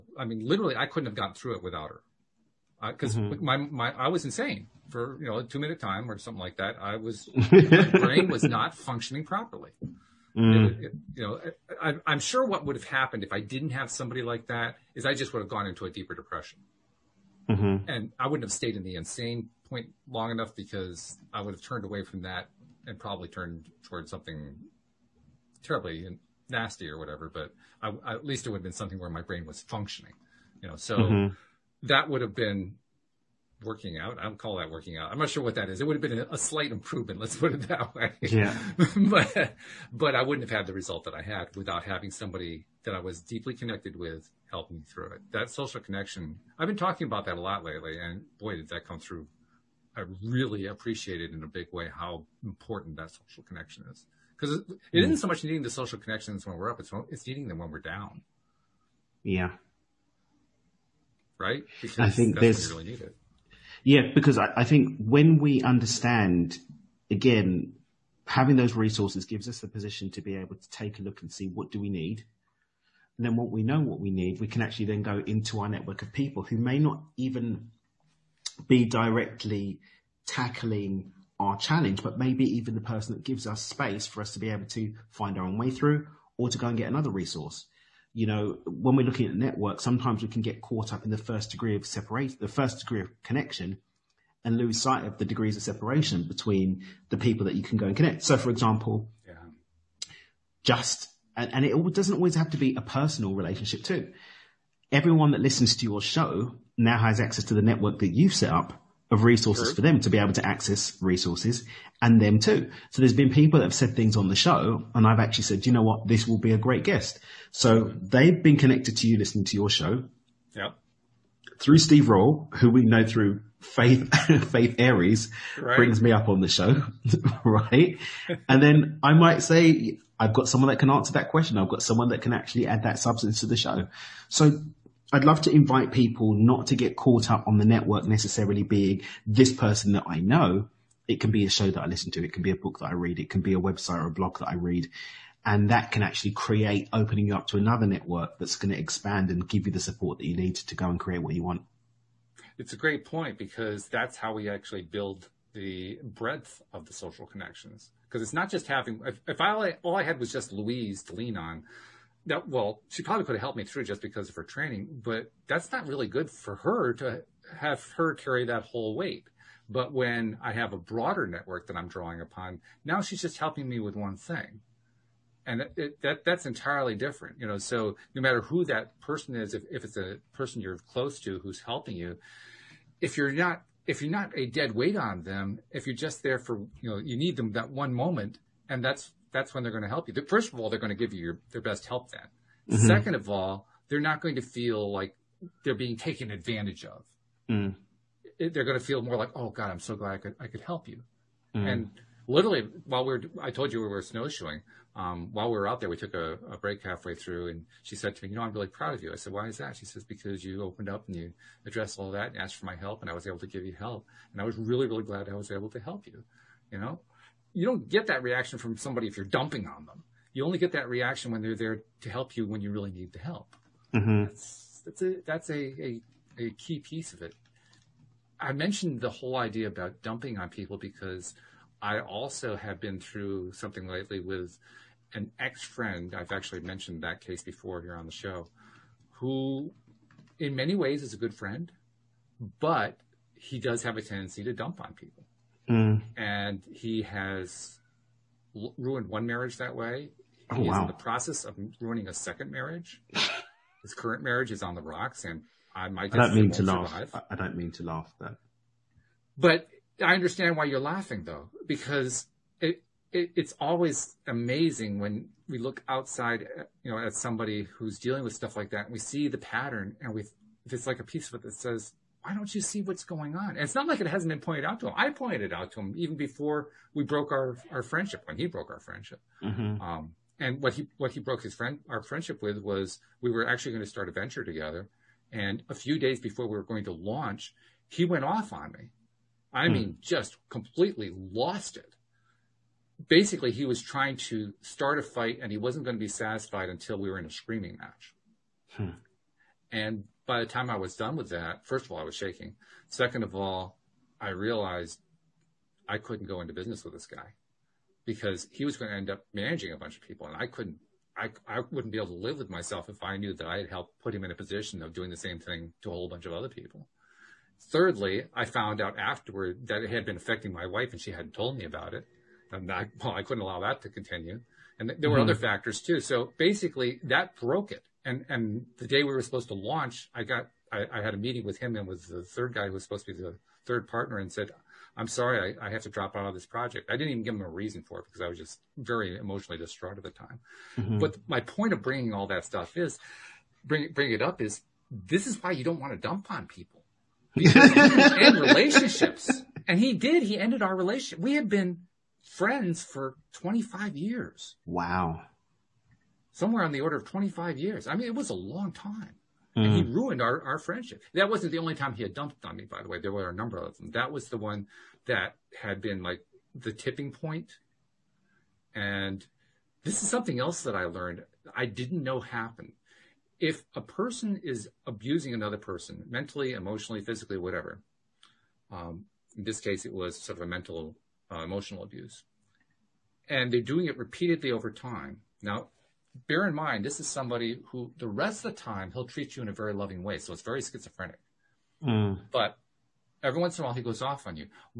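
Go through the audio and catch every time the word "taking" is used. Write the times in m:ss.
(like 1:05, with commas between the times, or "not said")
not said.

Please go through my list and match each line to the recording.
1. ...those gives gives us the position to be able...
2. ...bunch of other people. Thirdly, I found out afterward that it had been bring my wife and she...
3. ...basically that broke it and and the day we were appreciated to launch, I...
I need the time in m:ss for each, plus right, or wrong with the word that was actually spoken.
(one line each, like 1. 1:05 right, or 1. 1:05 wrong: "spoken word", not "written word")
1. 1:08 wrong: "resources", not "gives"
2. 5:16 wrong: "affecting", not "bring"
3. 5:26 wrong: "supposed", not "appreciated".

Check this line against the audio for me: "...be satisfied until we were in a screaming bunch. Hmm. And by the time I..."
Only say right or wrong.
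wrong.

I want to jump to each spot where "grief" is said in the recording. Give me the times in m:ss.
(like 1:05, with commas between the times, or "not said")
not said.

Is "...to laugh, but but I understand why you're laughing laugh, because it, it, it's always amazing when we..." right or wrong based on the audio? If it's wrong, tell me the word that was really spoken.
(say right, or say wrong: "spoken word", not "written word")
wrong: "though", not "laugh".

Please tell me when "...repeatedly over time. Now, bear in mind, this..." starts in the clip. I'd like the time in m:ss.
6:23.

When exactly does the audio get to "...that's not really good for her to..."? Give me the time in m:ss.
2:45.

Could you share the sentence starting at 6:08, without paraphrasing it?
And this is something else that I learned I didn't know happened.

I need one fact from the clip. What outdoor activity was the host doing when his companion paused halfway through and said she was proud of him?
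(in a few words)
Snowshoeing.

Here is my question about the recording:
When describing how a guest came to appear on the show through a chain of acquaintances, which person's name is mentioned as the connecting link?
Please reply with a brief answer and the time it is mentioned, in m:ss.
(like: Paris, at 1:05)
Steve Roll, at 2:01.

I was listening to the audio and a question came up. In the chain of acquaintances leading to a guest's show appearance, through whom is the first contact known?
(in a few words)
Faith Aries.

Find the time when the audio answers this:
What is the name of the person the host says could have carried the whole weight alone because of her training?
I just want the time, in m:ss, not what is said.
2:40.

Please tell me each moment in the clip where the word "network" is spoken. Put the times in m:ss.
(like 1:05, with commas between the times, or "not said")
1:15, 1:29, 1:47, 2:17, 2:27, 2:51.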